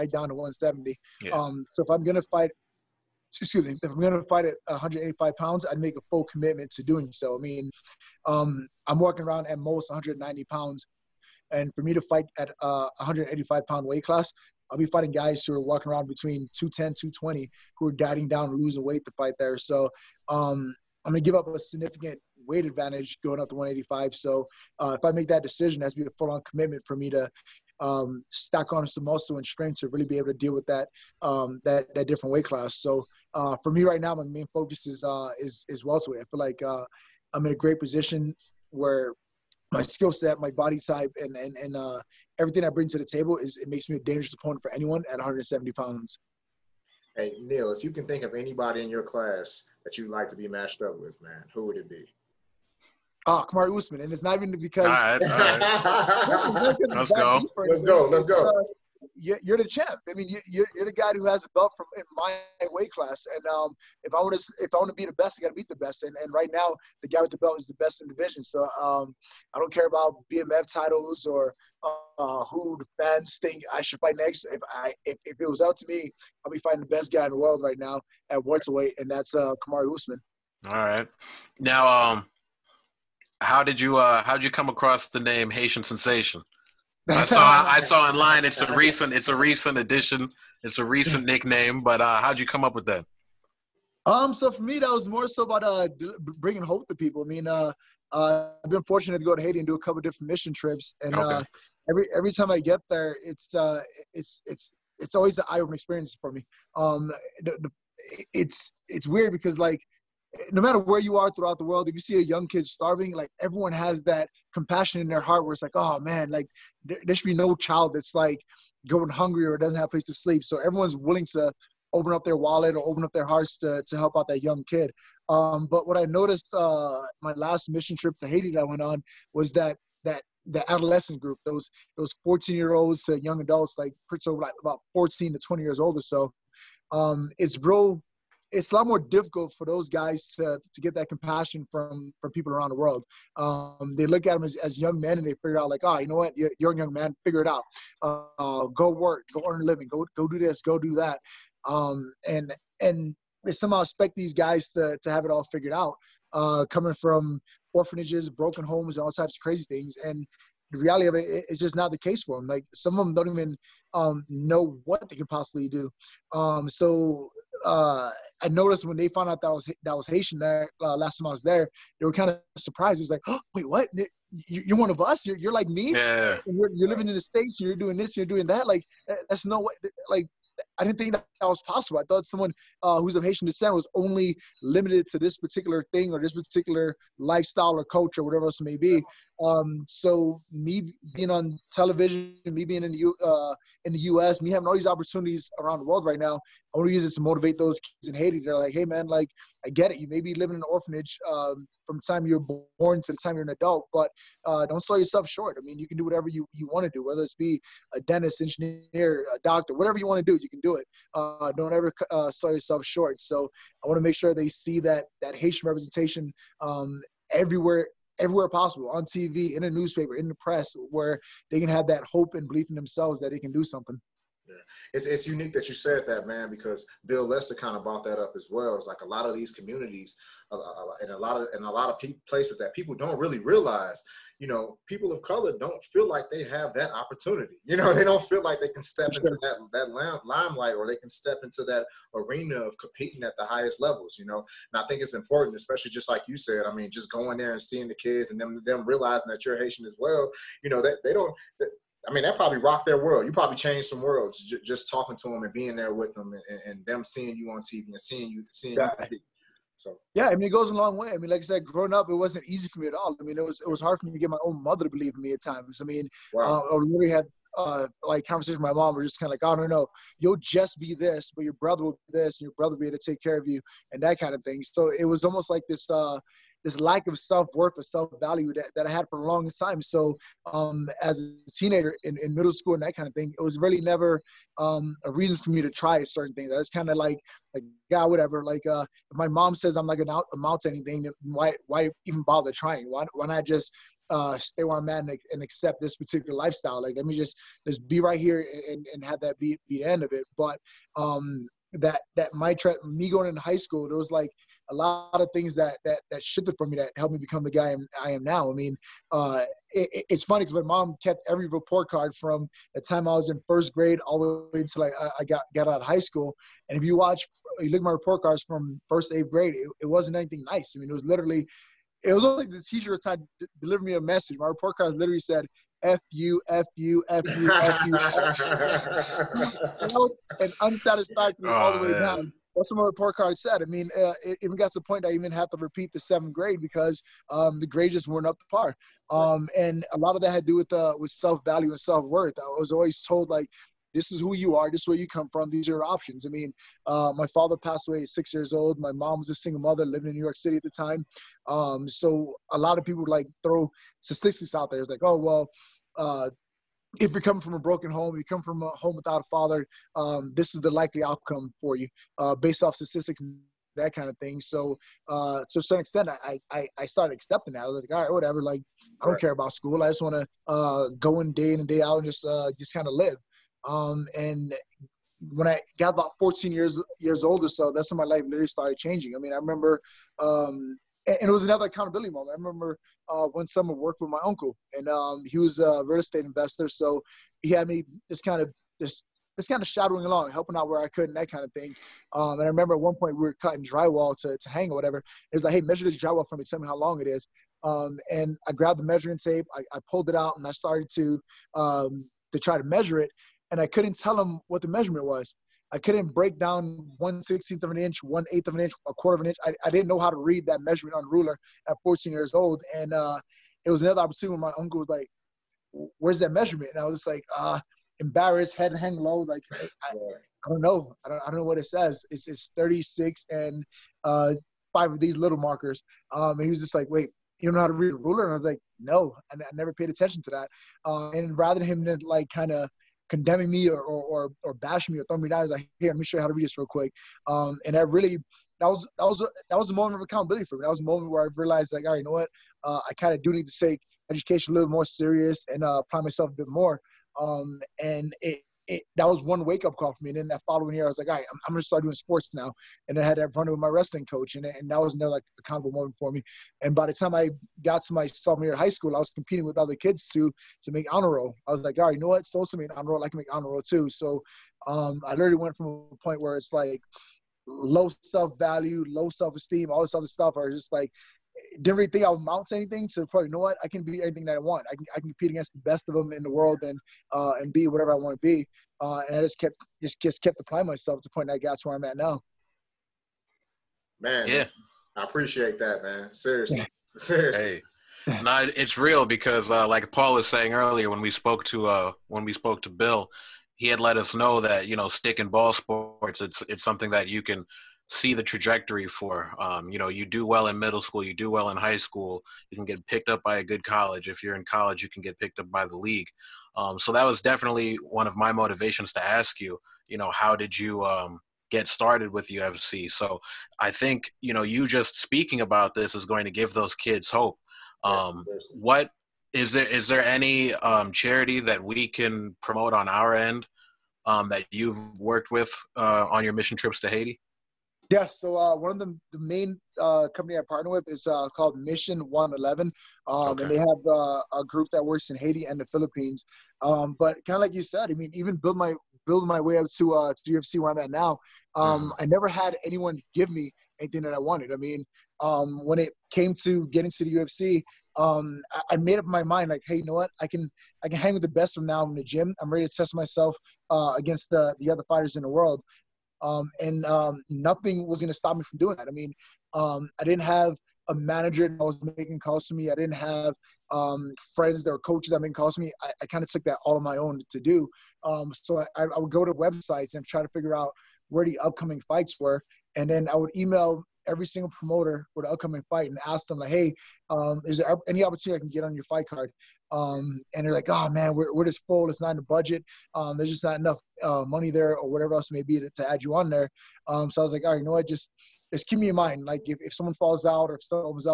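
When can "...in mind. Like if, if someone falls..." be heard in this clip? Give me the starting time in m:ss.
9:48.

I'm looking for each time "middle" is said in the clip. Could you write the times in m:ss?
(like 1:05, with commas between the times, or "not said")
4:42, 8:20.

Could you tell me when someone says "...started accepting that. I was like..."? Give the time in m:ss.
6:06.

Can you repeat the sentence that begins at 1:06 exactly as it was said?
And, and right now, the guy with the belt is the best in the division.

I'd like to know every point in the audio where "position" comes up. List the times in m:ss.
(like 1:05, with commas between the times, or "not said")
0:37.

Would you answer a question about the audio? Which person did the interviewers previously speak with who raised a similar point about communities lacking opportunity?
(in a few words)
Bill Lester.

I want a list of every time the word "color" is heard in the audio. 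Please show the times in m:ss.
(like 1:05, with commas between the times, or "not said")
3:55.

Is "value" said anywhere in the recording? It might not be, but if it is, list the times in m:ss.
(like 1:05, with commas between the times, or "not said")
4:37, 5:41, 7:48.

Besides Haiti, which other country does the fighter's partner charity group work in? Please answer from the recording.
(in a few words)
the Philippines.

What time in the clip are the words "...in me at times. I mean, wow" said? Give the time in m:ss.
4:25.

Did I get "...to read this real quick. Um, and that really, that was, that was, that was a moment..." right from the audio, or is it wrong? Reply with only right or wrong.
right.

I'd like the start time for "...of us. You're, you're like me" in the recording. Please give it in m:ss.
2:54.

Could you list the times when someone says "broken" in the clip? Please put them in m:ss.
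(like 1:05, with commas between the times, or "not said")
2:38, 5:57.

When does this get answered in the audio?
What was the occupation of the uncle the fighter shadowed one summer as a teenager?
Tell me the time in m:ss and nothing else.
6:25.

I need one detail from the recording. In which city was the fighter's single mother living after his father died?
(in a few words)
New York City.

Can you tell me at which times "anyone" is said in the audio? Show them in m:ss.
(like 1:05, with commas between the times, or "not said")
0:44, 9:02.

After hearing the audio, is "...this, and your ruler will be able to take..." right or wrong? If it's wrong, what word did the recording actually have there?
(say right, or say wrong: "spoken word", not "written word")
wrong: "brother", not "ruler".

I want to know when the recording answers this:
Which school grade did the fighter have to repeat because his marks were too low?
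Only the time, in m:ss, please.
5:35.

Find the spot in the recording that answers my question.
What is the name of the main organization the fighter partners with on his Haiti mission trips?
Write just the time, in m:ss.
8:51.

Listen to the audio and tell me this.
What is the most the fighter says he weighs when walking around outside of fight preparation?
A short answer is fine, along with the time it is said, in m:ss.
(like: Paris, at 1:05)
190 pounds, at 0:09.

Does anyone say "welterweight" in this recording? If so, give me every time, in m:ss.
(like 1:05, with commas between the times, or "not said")
0:35, 1:18.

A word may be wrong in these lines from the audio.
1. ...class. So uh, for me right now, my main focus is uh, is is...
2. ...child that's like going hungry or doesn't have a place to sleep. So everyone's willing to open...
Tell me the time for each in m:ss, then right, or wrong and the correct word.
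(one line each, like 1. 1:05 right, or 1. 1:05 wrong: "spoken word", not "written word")
1. 0:32 right
2. 1:57 right.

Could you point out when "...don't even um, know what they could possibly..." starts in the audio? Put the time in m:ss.
2:43.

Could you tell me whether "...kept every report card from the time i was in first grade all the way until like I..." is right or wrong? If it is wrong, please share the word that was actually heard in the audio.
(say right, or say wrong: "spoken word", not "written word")
right.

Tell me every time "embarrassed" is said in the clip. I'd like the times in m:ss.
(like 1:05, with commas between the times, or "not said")
6:57.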